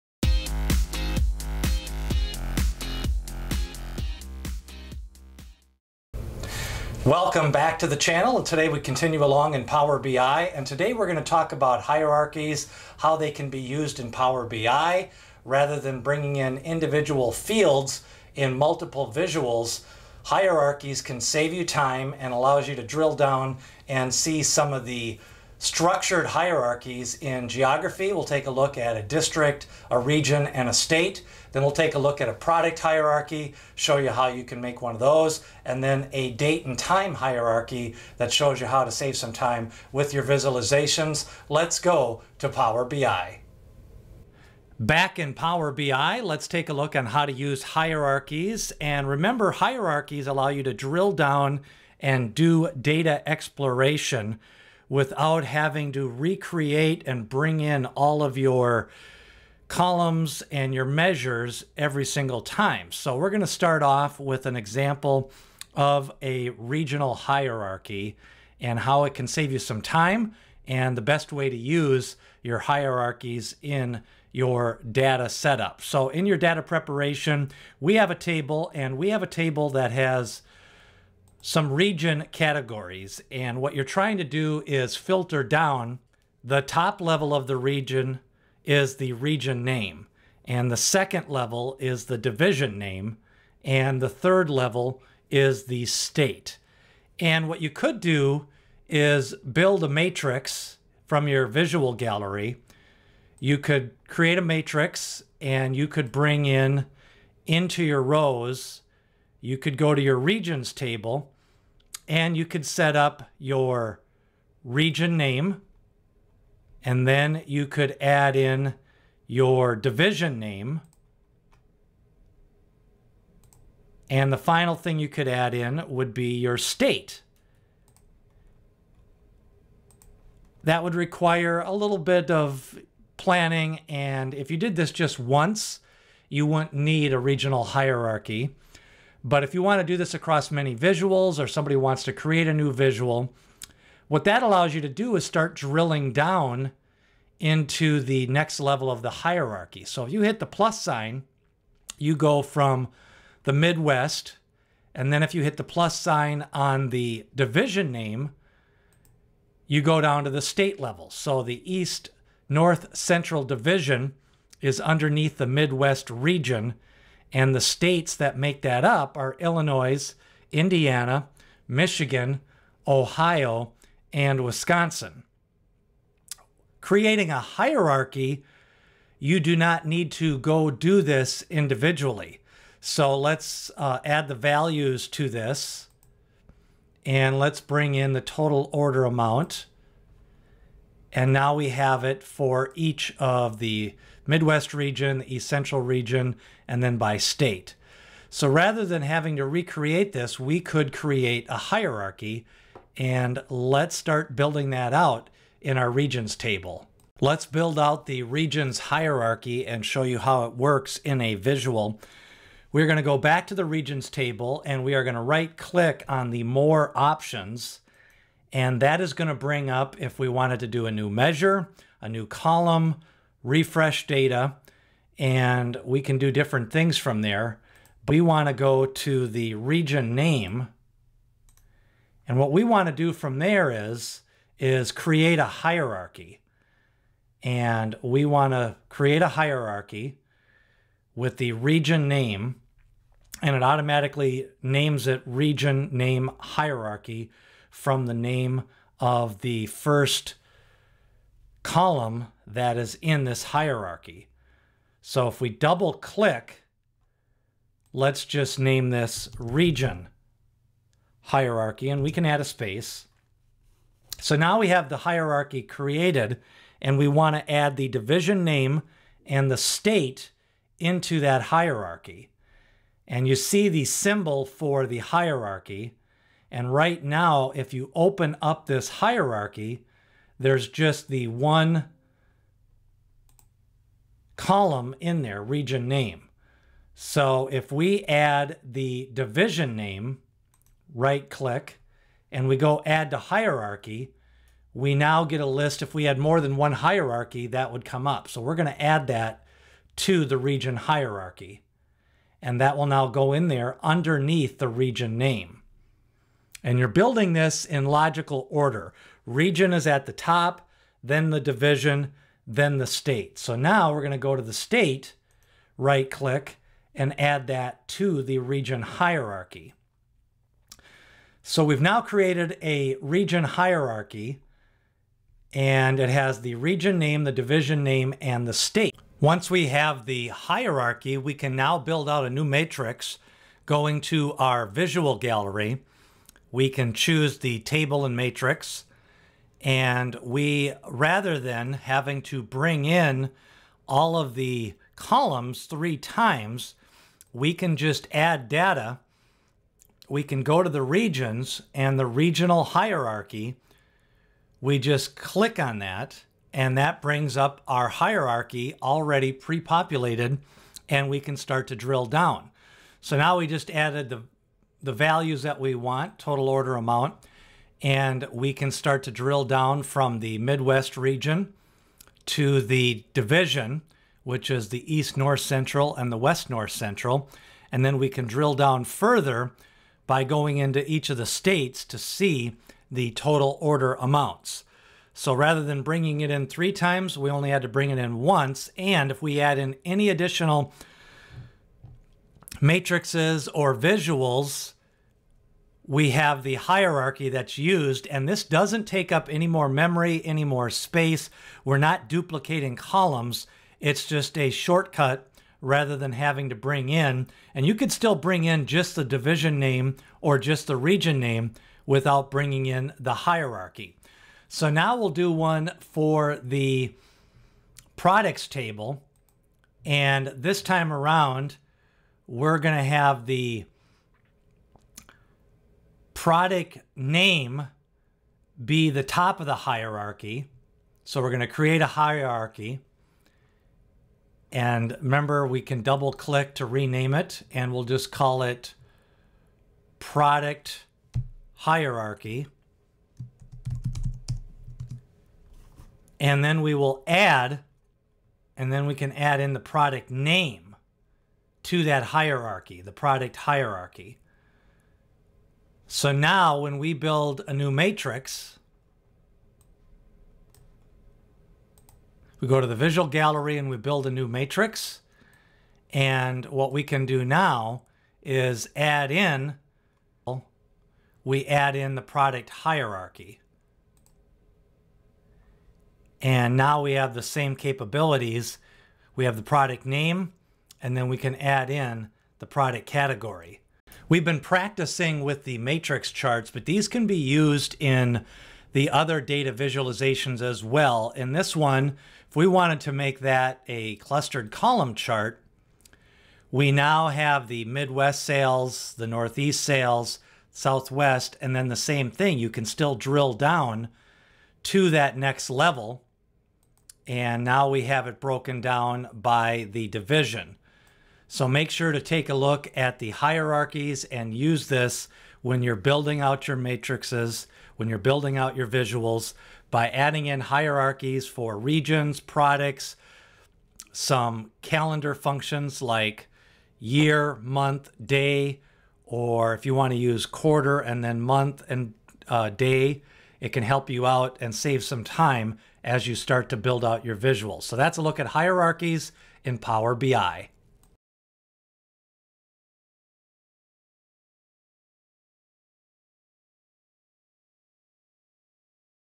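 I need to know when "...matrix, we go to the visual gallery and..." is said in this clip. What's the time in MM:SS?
07:37.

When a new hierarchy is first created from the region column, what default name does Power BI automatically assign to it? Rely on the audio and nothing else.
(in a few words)
Region name hierarchy.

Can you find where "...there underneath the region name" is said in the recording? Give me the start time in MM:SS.
05:03.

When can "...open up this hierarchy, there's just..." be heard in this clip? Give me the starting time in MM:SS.
04:37.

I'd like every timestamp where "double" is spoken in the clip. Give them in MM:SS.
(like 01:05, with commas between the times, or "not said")
04:15, 07:15.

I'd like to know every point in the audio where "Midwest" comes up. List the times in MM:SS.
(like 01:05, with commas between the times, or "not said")
02:33, 02:45, 03:14, 06:10, 08:17.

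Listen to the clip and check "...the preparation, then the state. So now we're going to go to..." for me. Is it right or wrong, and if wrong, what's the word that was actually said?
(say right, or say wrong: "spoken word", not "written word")
wrong: "division", not "preparation".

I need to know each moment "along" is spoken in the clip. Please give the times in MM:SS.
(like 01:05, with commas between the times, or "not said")
00:09.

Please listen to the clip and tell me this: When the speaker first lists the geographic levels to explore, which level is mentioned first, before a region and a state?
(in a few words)
District.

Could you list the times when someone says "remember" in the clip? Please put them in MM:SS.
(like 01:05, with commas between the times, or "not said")
00:49, 07:15.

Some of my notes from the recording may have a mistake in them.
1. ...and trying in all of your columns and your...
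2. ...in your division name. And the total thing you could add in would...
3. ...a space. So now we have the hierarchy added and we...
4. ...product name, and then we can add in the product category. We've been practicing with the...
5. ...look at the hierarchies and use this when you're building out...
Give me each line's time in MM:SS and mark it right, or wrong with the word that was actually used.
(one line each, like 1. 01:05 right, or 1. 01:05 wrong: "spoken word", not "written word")
1. 00:57 wrong: "bring", not "trying"
2. 01:58 wrong: "final", not "total"
3. 04:22 wrong: "created", not "added"
4. 07:59 right
5. 08:32 right.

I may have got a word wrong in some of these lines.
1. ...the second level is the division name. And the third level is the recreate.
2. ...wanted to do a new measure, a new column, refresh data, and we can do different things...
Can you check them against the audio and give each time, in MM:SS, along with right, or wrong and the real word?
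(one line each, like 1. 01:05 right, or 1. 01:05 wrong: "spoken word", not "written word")
1. 01:30 wrong: "state", not "recreate"
2. 03:40 right.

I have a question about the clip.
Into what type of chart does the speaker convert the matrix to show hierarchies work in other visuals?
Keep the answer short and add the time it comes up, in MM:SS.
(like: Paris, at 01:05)
Clustered column chart, at 08:13.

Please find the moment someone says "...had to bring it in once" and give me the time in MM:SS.
06:27.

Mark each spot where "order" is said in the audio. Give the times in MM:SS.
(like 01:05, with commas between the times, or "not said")
03:08, 05:08, 06:06, 06:23.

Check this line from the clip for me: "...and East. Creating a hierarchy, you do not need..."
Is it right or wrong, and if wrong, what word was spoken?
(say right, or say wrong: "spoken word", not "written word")
wrong: "Wisconsin", not "East".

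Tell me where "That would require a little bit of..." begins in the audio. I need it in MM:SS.
02:10.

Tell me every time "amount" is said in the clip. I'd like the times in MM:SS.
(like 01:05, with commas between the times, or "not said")
03:09, 06:06, 06:23.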